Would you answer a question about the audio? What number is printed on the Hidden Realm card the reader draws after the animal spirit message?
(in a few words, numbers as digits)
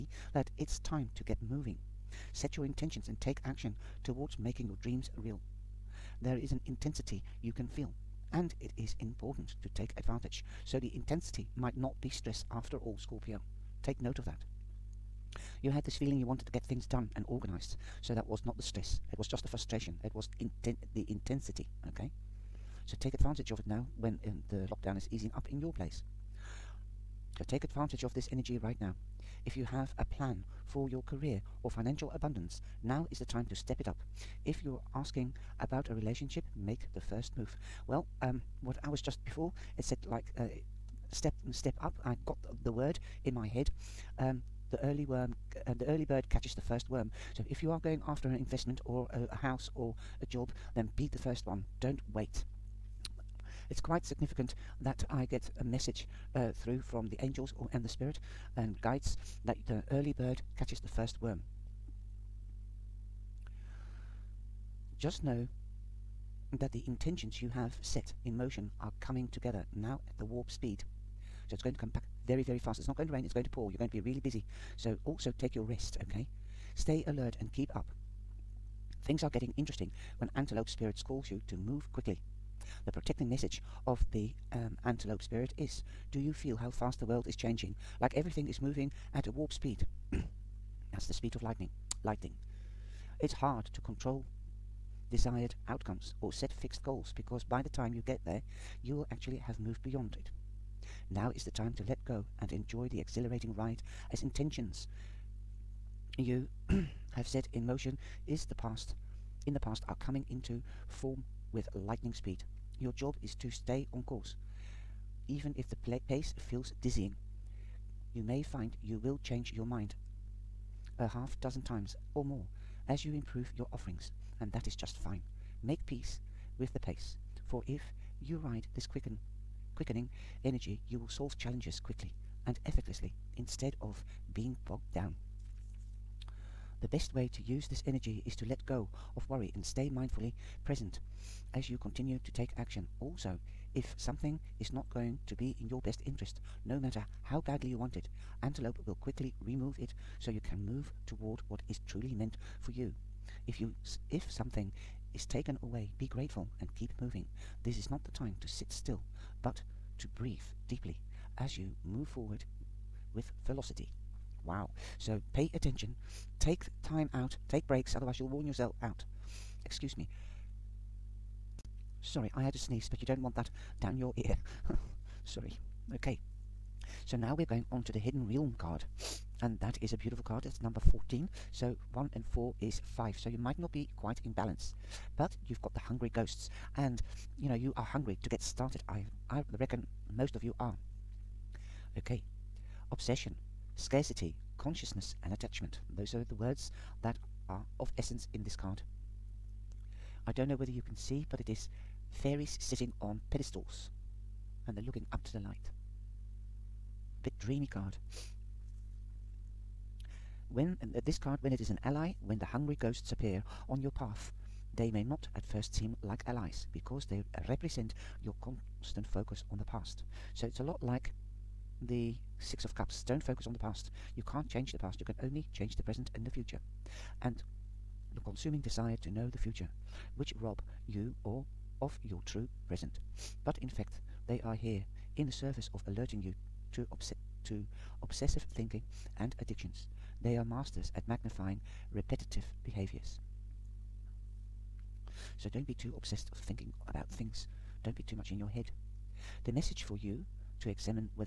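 14.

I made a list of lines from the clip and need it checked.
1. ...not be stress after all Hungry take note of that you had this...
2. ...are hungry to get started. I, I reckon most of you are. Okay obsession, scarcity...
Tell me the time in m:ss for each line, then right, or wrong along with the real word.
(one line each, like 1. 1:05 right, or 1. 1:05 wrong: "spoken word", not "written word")
1. 0:11 wrong: "Scorpio", not "Hungry"
2. 3:07 right.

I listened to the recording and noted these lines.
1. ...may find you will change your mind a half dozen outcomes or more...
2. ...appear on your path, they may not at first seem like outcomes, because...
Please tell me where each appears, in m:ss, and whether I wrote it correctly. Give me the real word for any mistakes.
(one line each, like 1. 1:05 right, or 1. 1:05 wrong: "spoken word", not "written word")
1. 1:58 wrong: "times", not "outcomes"
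2. 3:33 wrong: "allies", not "outcomes".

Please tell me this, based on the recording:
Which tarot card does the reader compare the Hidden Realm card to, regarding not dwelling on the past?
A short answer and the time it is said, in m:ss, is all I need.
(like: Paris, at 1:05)
Six of Cups, at 3:42.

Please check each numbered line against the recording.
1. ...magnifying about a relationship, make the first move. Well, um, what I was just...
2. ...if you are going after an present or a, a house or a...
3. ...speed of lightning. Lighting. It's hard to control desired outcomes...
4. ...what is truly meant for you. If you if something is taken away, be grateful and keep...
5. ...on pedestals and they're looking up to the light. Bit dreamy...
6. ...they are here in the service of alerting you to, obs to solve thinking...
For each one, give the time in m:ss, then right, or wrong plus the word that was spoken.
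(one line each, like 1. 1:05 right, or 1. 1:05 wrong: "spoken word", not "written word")
1. 0:34 wrong: "asking", not "magnifying"
2. 0:47 wrong: "investment", not "present"
3. 1:31 right
4. 2:31 right
5. 3:23 right
6. 3:54 wrong: "obsessive", not "solve".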